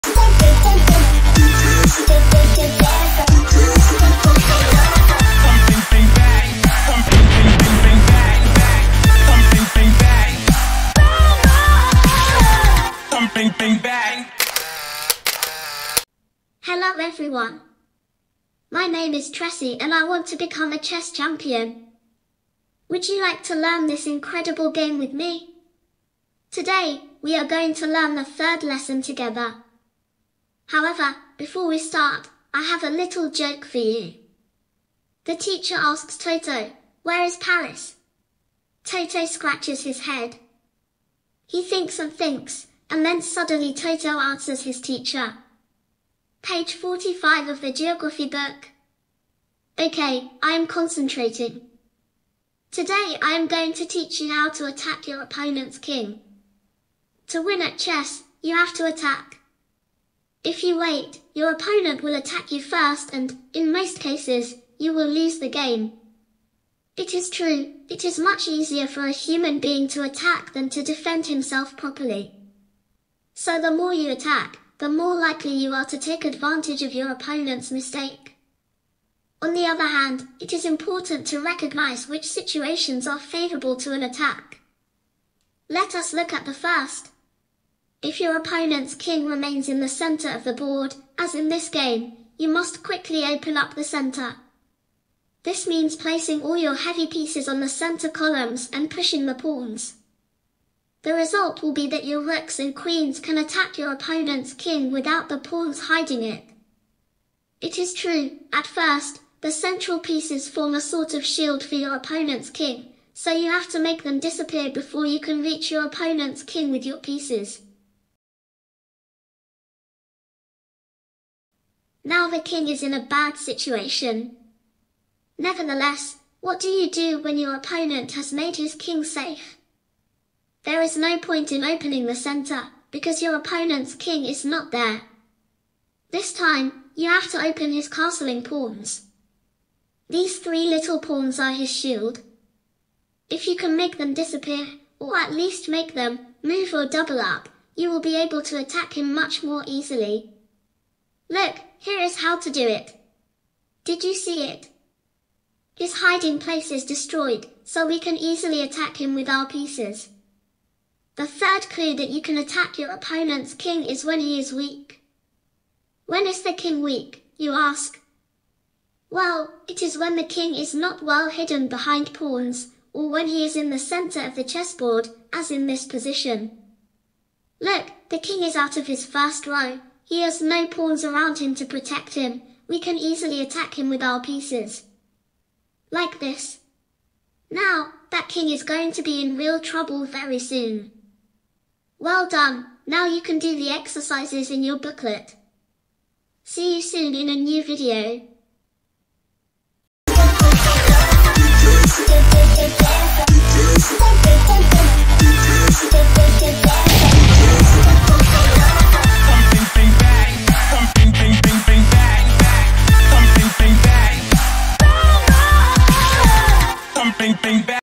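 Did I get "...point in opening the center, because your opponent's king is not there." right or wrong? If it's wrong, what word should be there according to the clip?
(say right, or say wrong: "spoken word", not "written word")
right.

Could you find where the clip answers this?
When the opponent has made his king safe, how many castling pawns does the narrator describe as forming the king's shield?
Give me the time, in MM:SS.
02:20.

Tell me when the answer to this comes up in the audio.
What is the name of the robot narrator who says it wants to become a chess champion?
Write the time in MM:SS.
00:19.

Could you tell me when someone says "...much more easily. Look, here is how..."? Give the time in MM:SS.
02:29.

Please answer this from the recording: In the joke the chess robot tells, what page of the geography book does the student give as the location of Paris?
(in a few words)
45.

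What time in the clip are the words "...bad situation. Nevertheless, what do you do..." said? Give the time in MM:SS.
02:03.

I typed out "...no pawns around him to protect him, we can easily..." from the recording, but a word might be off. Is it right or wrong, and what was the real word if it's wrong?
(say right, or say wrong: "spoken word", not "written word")
right.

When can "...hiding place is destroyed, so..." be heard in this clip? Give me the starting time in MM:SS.
02:36.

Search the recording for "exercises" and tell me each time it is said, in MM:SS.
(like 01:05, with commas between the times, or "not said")
03:13.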